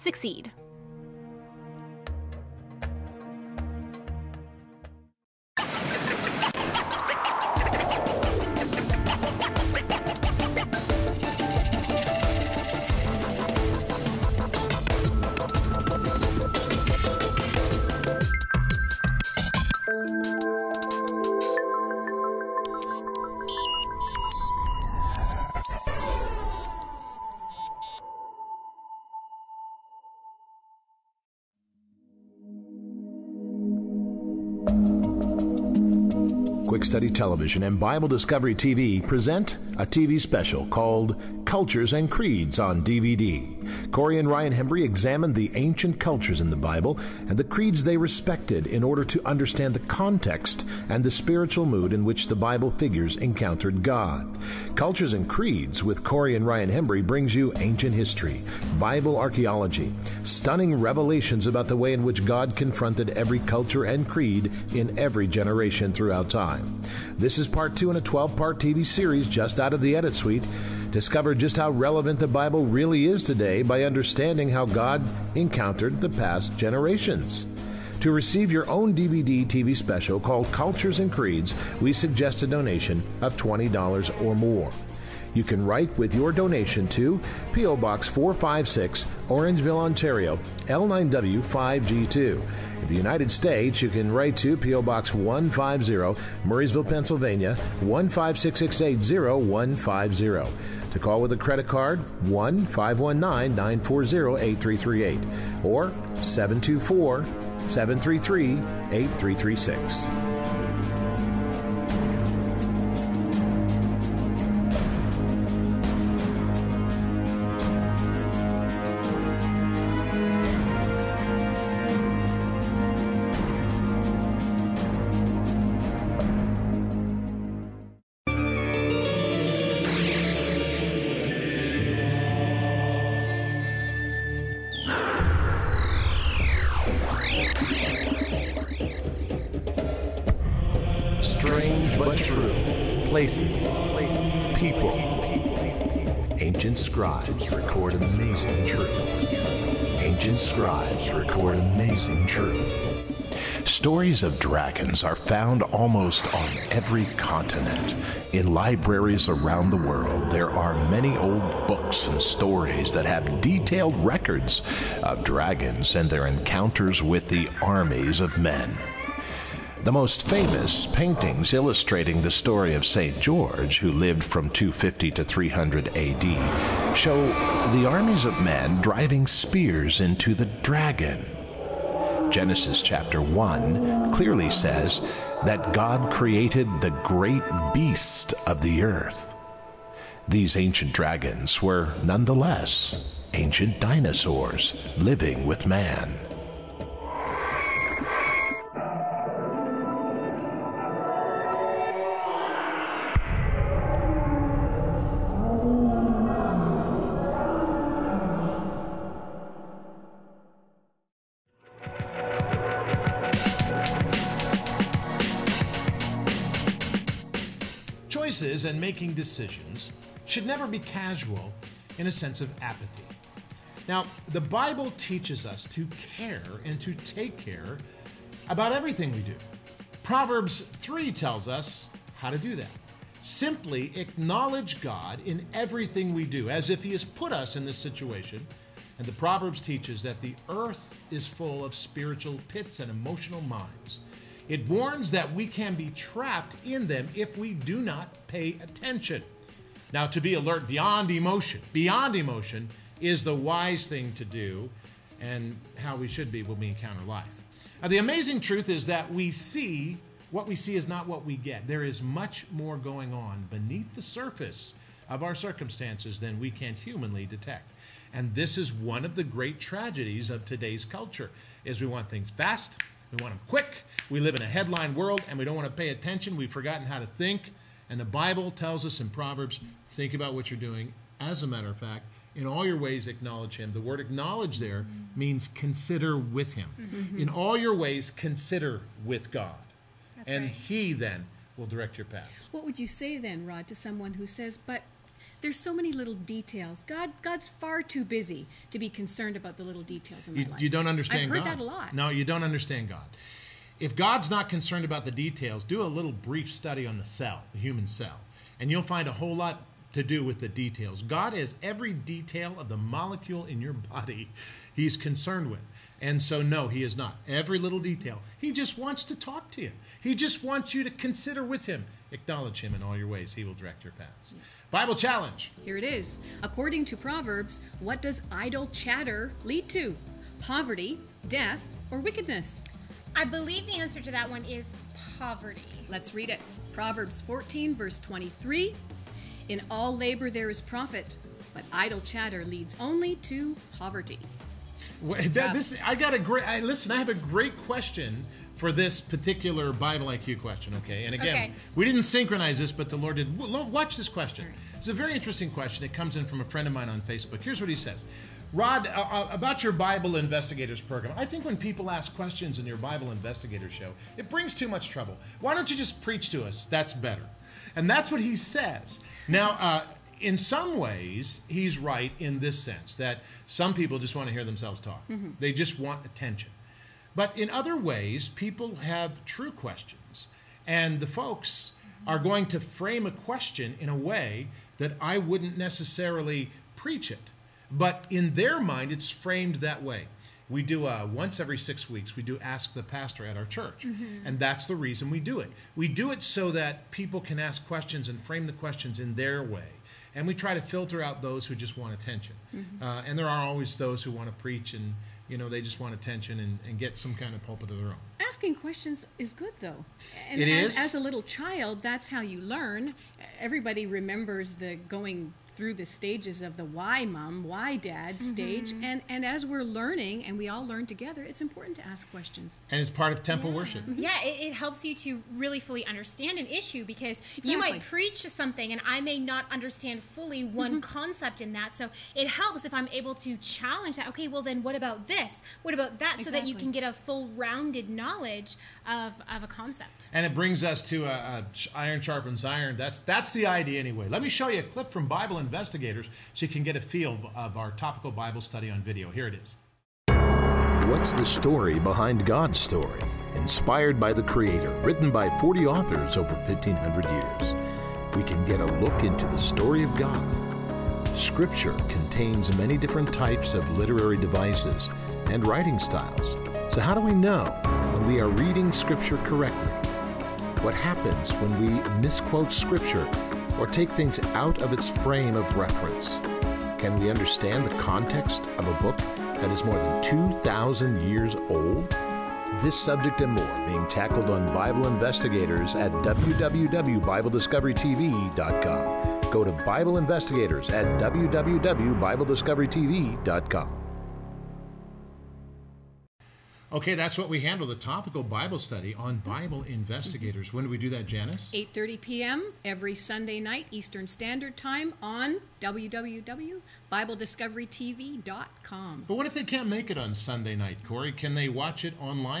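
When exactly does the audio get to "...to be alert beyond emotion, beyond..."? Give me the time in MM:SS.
04:10.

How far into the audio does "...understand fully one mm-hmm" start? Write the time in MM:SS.
07:09.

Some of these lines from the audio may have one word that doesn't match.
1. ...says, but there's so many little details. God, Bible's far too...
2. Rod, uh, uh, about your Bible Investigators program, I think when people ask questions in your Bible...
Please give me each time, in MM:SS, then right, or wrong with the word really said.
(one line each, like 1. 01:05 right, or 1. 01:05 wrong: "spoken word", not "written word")
1. 04:54 wrong: "God", not "Bible"
2. 05:58 right.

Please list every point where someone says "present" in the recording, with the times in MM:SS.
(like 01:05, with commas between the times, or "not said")
00:39.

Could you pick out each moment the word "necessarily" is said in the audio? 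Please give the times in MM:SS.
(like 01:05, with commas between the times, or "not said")
06:25.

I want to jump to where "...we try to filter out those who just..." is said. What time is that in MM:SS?
06:40.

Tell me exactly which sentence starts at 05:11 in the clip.
God has every detail of the molecule in your body he's concerned with.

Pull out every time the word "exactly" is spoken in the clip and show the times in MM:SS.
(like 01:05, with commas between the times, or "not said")
07:07, 07:16.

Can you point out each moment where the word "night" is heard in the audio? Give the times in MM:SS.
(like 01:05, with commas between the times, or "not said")
08:23, 08:30.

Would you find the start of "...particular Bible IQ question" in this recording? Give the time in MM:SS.
05:49.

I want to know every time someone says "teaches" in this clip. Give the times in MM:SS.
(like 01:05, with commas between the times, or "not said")
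03:44, 03:59.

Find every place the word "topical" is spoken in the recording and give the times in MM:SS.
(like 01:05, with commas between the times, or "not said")
07:27, 08:17.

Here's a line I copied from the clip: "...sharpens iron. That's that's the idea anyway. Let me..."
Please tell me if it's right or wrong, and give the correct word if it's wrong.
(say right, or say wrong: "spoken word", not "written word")
right.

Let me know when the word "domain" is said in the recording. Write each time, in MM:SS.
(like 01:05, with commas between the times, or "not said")
not said.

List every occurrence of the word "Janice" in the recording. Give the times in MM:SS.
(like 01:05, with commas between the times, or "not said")
08:21.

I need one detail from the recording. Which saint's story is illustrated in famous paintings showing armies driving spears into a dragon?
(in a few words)
St. George.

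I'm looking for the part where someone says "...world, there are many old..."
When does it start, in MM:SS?
02:39.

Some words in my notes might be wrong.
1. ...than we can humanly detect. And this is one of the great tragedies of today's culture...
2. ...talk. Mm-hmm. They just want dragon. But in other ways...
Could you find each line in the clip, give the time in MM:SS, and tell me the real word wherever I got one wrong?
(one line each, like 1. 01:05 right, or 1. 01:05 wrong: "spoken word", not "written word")
1. 04:26 right
2. 06:14 wrong: "attention", not "dragon".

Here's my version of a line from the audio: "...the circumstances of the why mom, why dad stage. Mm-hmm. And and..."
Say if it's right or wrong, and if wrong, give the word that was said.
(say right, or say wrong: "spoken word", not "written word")
wrong: "stages", not "circumstances".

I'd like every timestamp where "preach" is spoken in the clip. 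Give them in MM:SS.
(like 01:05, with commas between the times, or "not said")
06:06, 06:26, 06:44, 07:07.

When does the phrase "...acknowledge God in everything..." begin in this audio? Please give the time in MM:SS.
03:53.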